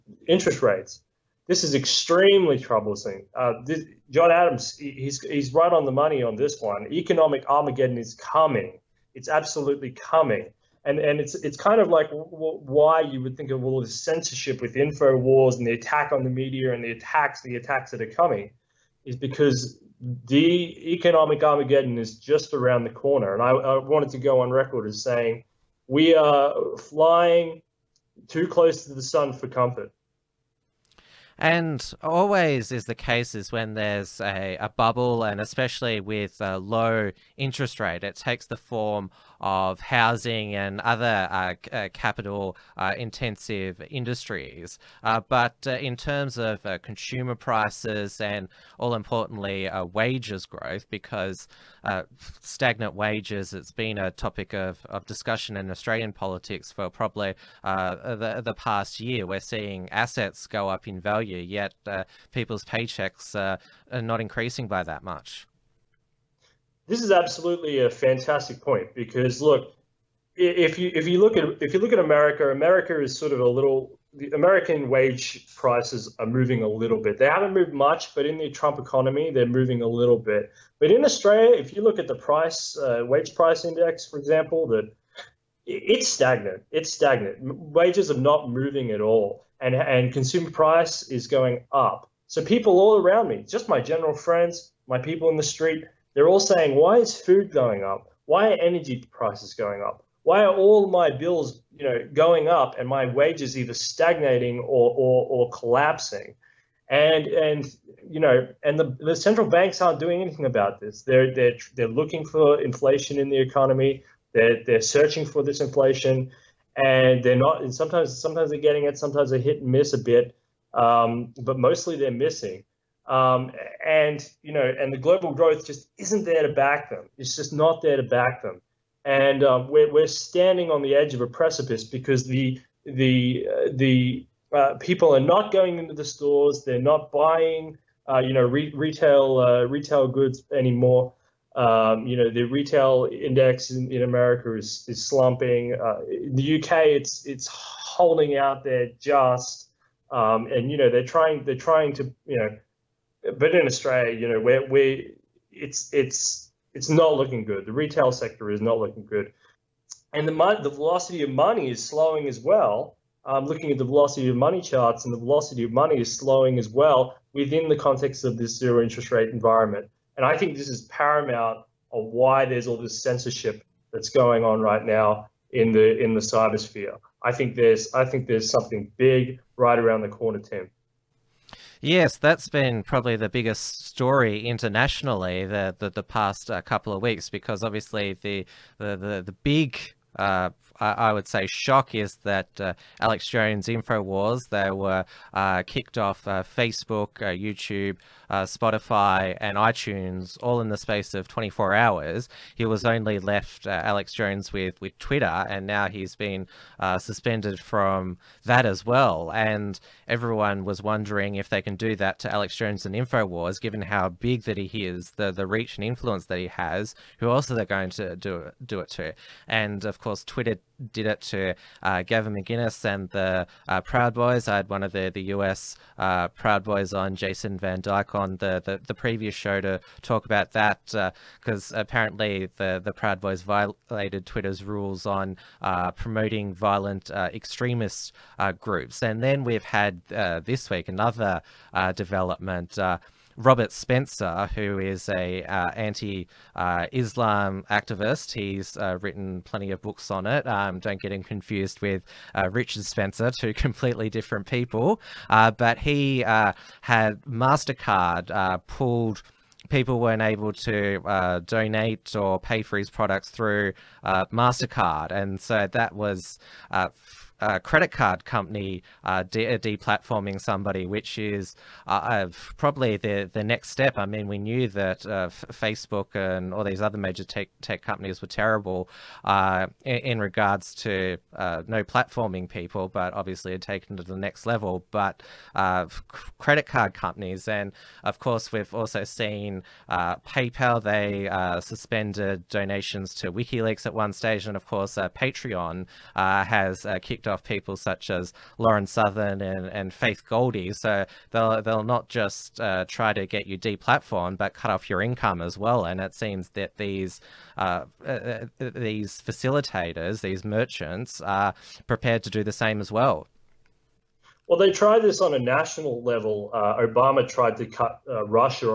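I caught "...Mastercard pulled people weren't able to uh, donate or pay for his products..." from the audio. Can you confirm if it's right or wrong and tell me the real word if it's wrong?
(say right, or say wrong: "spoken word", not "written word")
right.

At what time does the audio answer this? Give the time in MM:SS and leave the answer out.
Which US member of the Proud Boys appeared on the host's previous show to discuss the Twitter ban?
03:47.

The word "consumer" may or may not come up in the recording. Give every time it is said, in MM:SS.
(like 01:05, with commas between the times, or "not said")
00:46, 01:30.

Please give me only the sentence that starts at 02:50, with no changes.
And I think this is paramount of why there's all this censorship that's going on right now in the in the cybersphere.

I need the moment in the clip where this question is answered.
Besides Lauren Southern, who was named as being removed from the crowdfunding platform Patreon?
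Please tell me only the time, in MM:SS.
04:59.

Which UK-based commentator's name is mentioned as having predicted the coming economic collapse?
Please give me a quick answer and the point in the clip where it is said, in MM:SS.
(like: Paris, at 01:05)
John Adams, at 00:04.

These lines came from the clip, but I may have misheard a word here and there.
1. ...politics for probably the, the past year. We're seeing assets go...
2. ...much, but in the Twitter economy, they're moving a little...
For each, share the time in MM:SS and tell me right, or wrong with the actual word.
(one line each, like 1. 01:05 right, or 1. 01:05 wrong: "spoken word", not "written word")
1. 00:56 right
2. 01:17 wrong: "Trump", not "Twitter".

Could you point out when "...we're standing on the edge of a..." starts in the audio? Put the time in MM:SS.
02:09.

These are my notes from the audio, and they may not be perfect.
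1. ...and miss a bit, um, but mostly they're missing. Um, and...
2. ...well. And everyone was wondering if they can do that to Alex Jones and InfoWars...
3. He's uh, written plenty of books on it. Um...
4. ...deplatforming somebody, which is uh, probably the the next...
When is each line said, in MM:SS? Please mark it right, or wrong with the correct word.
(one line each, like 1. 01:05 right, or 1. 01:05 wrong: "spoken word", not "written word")
1. 01:59 right
2. 03:28 right
3. 04:08 right
4. 04:29 right.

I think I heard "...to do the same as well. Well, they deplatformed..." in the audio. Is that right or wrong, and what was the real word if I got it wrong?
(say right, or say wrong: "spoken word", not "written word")
wrong: "tried", not "deplatformed".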